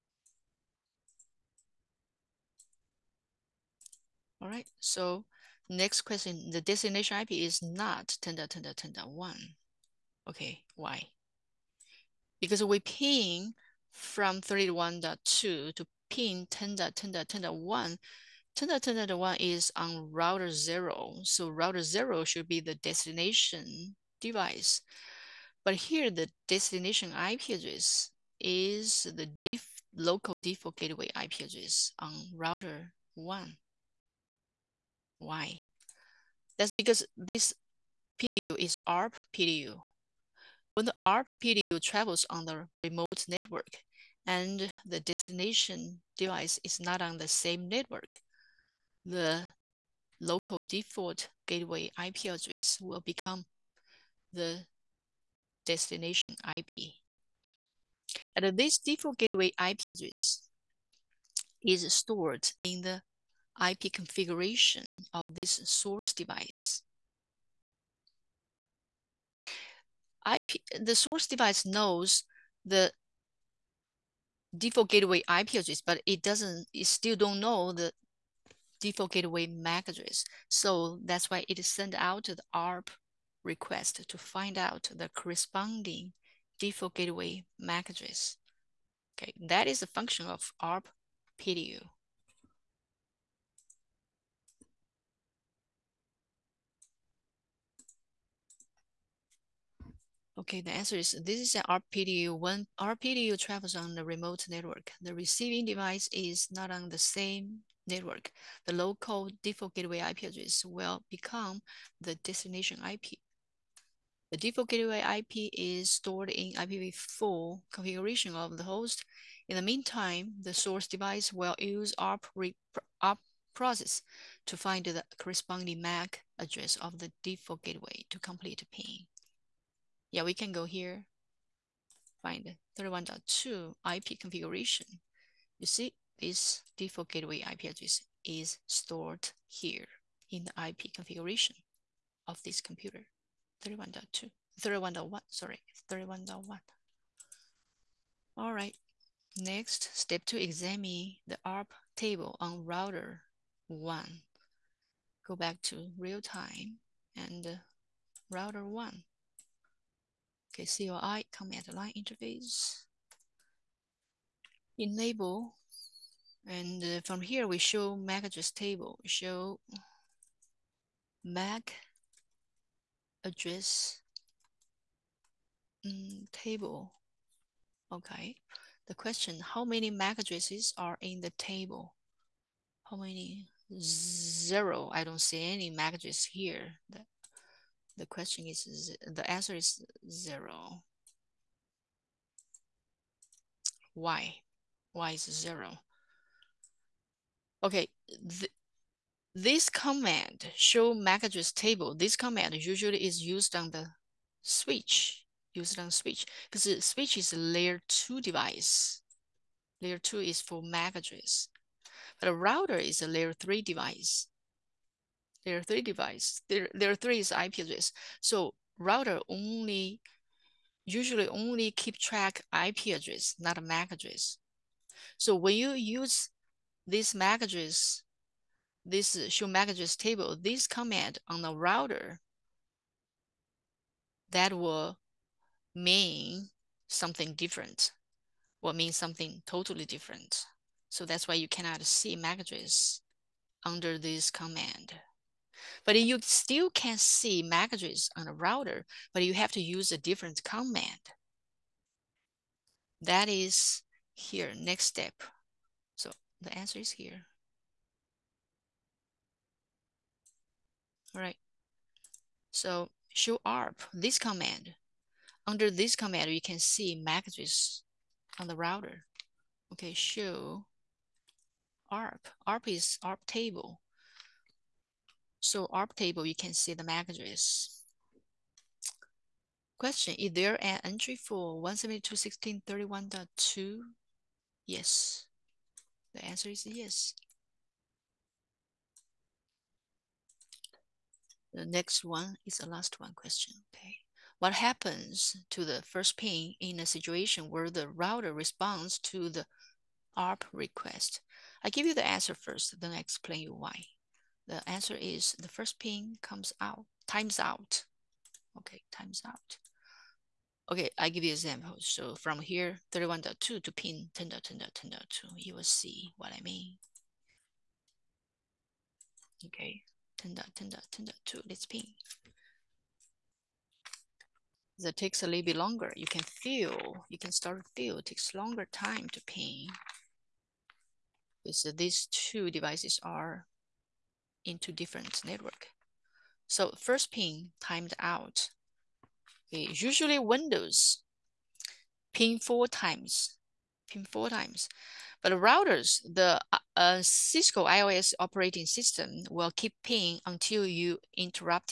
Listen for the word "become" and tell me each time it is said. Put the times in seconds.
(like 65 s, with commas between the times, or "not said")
53 s, 111 s.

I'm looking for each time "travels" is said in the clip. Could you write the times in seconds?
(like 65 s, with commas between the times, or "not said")
41 s, 103 s.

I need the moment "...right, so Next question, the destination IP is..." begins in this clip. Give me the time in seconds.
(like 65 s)
4 s.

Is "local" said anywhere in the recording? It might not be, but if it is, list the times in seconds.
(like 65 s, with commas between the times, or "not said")
29 s, 50 s, 108 s.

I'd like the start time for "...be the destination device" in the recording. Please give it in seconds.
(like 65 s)
22 s.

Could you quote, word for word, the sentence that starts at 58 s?
And this default gateway IP address is stored in the IP configuration of this source device.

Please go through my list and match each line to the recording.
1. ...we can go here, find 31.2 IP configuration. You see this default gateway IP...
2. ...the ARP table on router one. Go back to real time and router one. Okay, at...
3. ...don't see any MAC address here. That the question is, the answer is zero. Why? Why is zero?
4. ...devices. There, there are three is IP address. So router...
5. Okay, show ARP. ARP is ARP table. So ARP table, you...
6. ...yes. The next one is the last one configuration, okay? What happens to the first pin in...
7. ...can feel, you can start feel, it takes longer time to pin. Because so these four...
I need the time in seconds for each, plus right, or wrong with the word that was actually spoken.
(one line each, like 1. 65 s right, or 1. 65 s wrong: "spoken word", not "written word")
1. 130 s right
2. 151 s right
3. 185 s right
4. 215 s right
5. 269 s right
6. 286 s wrong: "question", not "configuration"
7. 326 s wrong: "two", not "four".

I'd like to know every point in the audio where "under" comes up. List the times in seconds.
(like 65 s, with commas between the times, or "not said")
243 s, 265 s.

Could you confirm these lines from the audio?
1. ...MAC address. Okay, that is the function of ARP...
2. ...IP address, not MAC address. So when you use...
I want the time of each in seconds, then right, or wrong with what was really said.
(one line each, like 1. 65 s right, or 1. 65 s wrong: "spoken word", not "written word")
1. 87 s right
2. 222 s right.